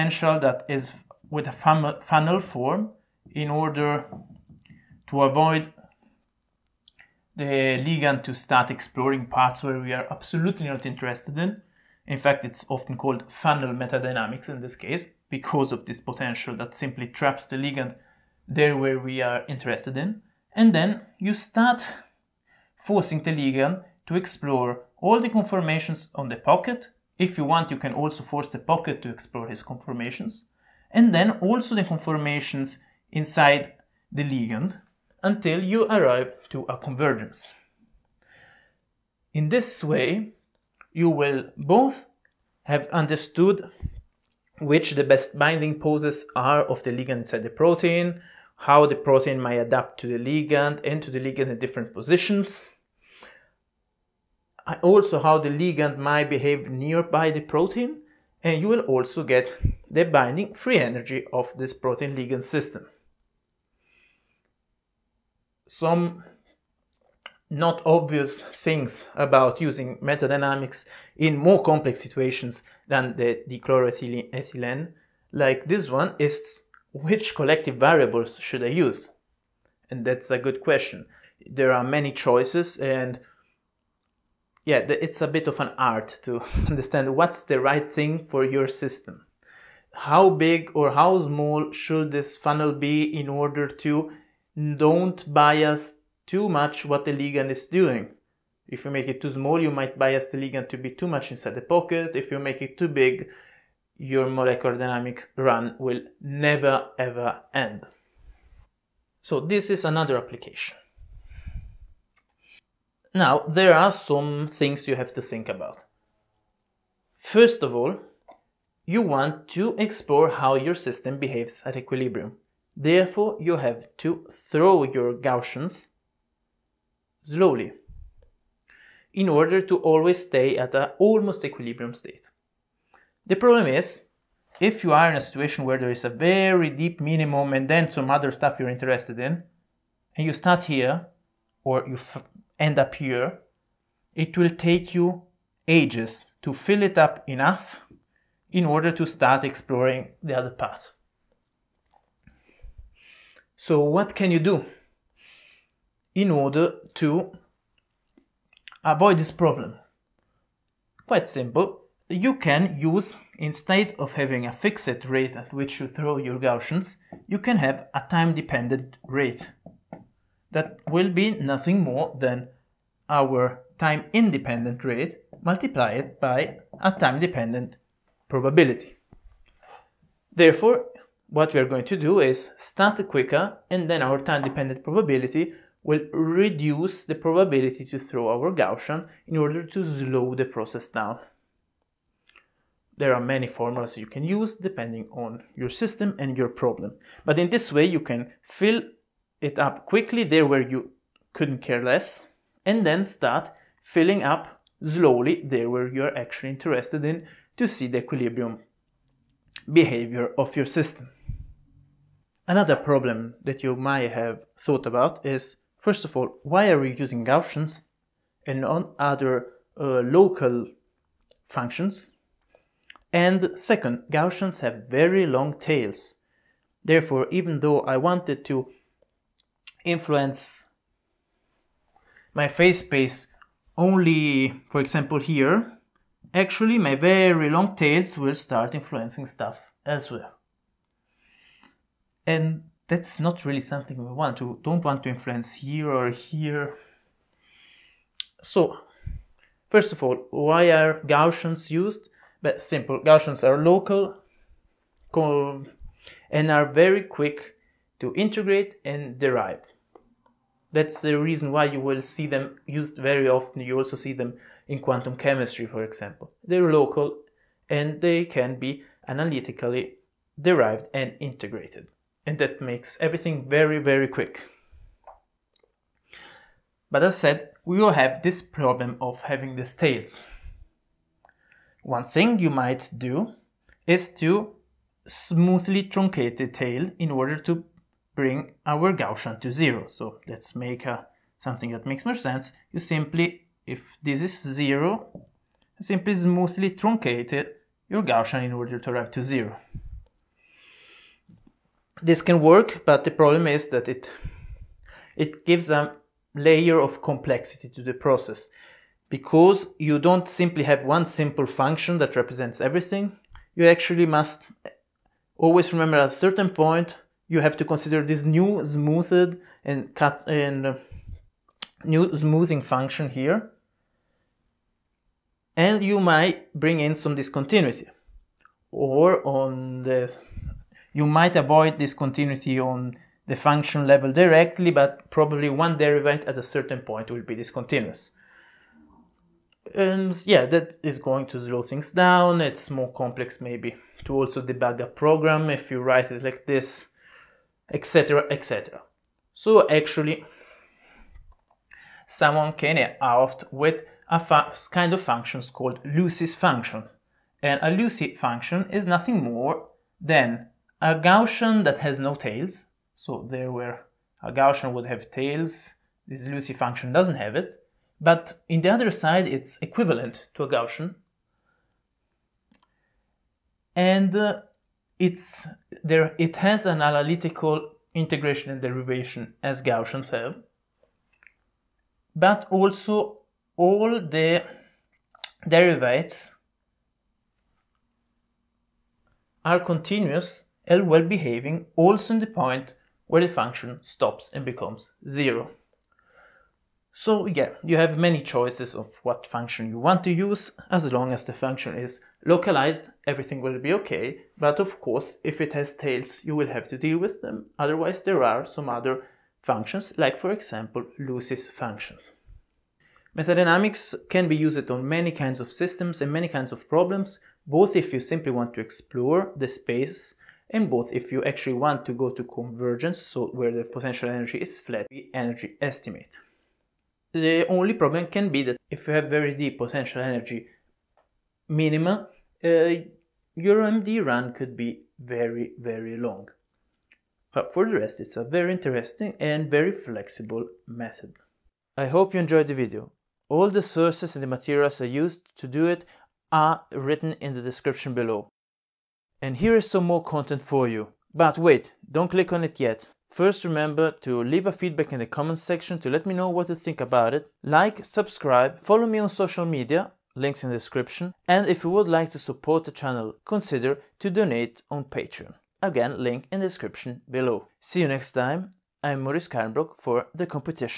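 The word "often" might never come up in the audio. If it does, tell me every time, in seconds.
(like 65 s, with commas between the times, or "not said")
12 s, 263 s.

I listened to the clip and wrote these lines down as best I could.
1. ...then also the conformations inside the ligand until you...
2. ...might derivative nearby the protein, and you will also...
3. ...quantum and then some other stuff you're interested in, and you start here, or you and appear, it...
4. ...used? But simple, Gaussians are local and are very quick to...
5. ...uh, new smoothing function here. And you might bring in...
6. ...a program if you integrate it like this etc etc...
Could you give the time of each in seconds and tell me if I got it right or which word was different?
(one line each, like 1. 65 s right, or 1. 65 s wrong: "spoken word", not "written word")
1. 31 s right
2. 55 s wrong: "behave", not "derivative"
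3. 136 s wrong: "minimum", not "quantum"
4. 251 s right
5. 320 s right
6. 344 s wrong: "write", not "integrate".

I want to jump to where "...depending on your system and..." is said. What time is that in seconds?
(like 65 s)
194 s.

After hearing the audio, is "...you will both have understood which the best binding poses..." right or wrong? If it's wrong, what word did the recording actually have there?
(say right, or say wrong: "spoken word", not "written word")
right.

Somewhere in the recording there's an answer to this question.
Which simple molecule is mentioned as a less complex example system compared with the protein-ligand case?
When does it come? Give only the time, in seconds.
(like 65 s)
73 s.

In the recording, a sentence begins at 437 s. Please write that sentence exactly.
But for the rest, it's a very interesting and very flexible method.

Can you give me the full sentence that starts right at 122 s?
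Therefore, you have to throw your Gaussians slowly in order to always stay at an almost equilibrium state.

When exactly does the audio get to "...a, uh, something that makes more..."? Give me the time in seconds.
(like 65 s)
290 s.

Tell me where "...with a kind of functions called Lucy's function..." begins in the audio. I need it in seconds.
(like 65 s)
353 s.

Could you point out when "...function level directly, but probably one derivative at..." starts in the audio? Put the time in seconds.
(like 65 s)
333 s.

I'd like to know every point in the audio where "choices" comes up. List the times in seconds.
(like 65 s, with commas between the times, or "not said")
82 s, 398 s.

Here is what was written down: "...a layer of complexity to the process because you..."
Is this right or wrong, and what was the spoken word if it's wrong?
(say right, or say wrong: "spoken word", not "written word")
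right.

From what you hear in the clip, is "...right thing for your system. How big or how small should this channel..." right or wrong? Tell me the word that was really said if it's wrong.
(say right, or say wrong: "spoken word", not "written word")
wrong: "funnel", not "channel".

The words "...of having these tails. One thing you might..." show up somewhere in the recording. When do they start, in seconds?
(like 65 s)
278 s.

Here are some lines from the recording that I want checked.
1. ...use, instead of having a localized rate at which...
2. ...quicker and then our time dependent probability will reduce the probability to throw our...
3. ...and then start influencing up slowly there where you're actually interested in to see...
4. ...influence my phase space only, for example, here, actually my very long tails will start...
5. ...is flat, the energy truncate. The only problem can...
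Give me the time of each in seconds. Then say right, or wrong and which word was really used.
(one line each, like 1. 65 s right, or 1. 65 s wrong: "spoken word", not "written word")
1. 162 s wrong: "fixed", not "localized"
2. 183 s right
3. 202 s wrong: "filling", not "influencing"
4. 229 s right
5. 424 s wrong: "estimate", not "truncate".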